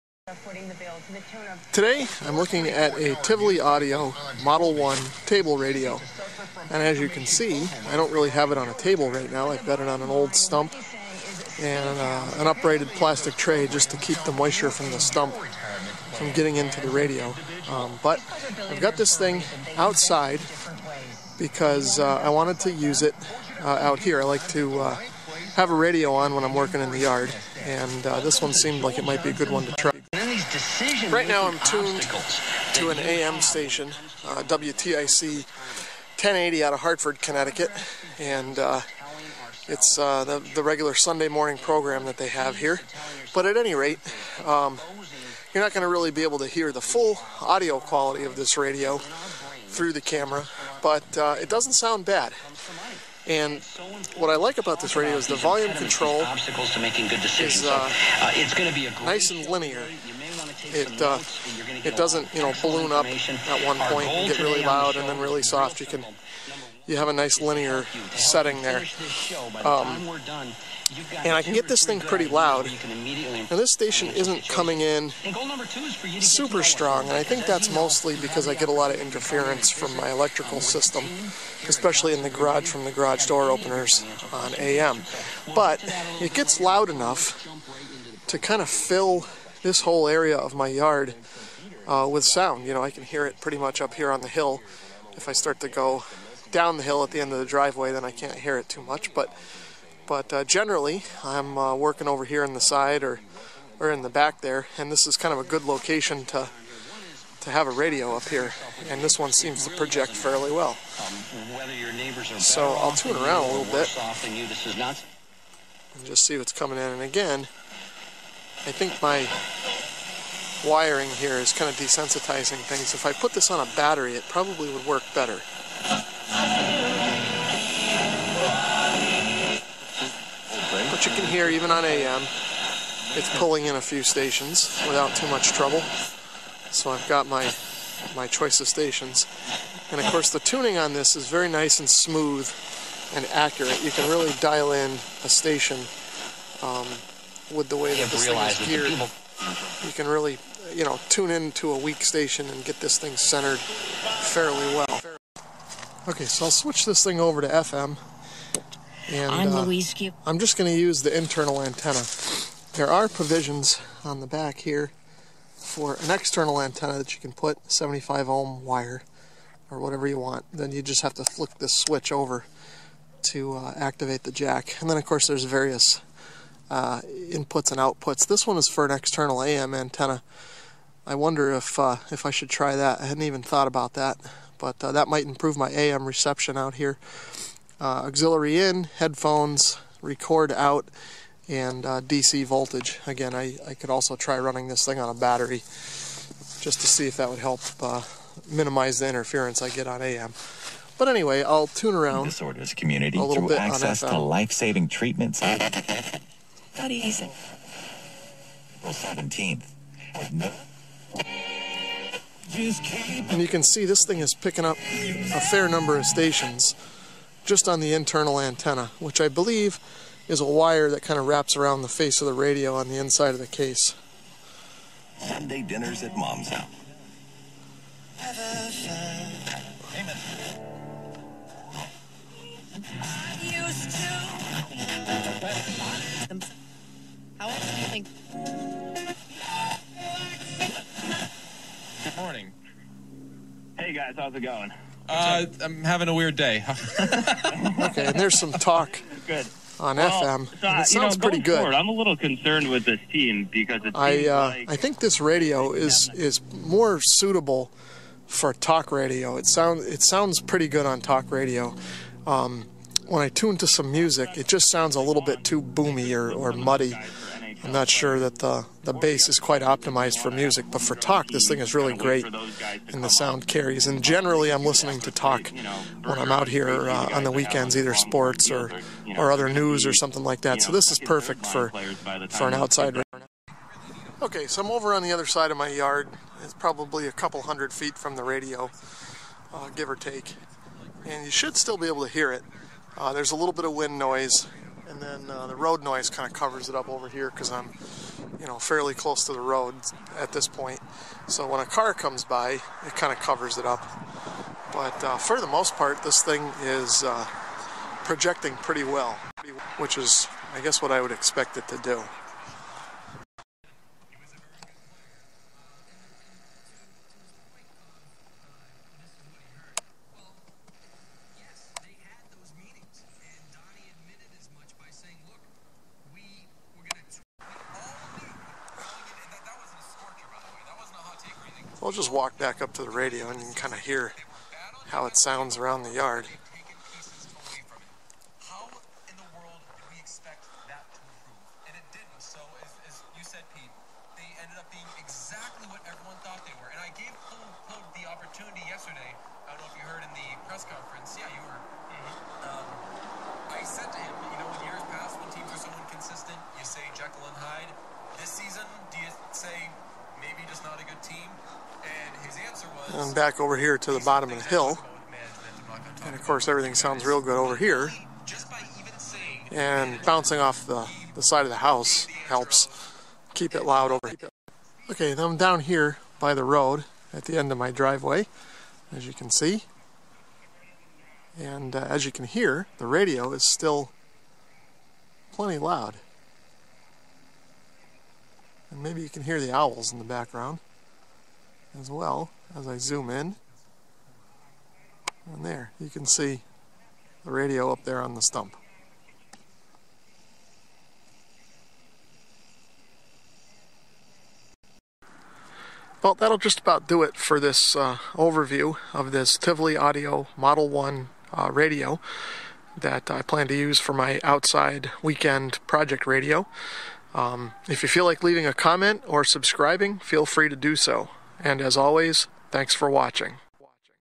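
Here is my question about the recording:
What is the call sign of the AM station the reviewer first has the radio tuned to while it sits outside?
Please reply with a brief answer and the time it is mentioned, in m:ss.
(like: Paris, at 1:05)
WTIC, at 0:34.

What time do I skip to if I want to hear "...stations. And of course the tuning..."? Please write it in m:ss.
2:18.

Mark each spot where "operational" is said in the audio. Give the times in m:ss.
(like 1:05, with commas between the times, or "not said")
not said.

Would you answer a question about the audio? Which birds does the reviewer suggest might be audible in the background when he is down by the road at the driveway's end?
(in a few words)
Owls.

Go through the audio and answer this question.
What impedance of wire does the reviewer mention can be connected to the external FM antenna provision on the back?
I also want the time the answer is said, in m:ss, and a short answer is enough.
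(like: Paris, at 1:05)
75 ohm, at 2:47.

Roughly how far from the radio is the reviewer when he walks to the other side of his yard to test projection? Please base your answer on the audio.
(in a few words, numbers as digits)
A couple hundred feet.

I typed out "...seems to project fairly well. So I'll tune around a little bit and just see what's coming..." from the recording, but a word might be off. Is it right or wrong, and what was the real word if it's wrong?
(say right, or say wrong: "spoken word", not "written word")
right.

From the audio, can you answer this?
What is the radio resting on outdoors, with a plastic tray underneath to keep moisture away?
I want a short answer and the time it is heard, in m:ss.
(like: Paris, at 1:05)
An old stump, at 0:10.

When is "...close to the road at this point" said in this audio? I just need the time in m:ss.
4:58.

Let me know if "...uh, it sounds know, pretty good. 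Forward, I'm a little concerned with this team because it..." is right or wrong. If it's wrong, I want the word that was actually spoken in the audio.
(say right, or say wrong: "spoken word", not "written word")
right.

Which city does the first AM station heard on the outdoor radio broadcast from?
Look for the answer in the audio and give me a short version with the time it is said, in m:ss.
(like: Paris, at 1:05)
Hartford, Connecticut, at 0:36.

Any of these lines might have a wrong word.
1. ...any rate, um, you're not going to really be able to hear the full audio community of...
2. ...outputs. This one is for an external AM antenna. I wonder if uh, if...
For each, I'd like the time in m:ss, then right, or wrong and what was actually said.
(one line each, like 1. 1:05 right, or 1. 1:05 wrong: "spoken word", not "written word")
1. 0:43 wrong: "quality", not "community"
2. 2:57 right.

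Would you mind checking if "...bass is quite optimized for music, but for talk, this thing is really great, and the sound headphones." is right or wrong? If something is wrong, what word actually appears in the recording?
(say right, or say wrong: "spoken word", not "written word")
wrong: "carries", not "headphones".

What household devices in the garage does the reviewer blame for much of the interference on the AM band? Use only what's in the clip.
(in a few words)
Garage door openers.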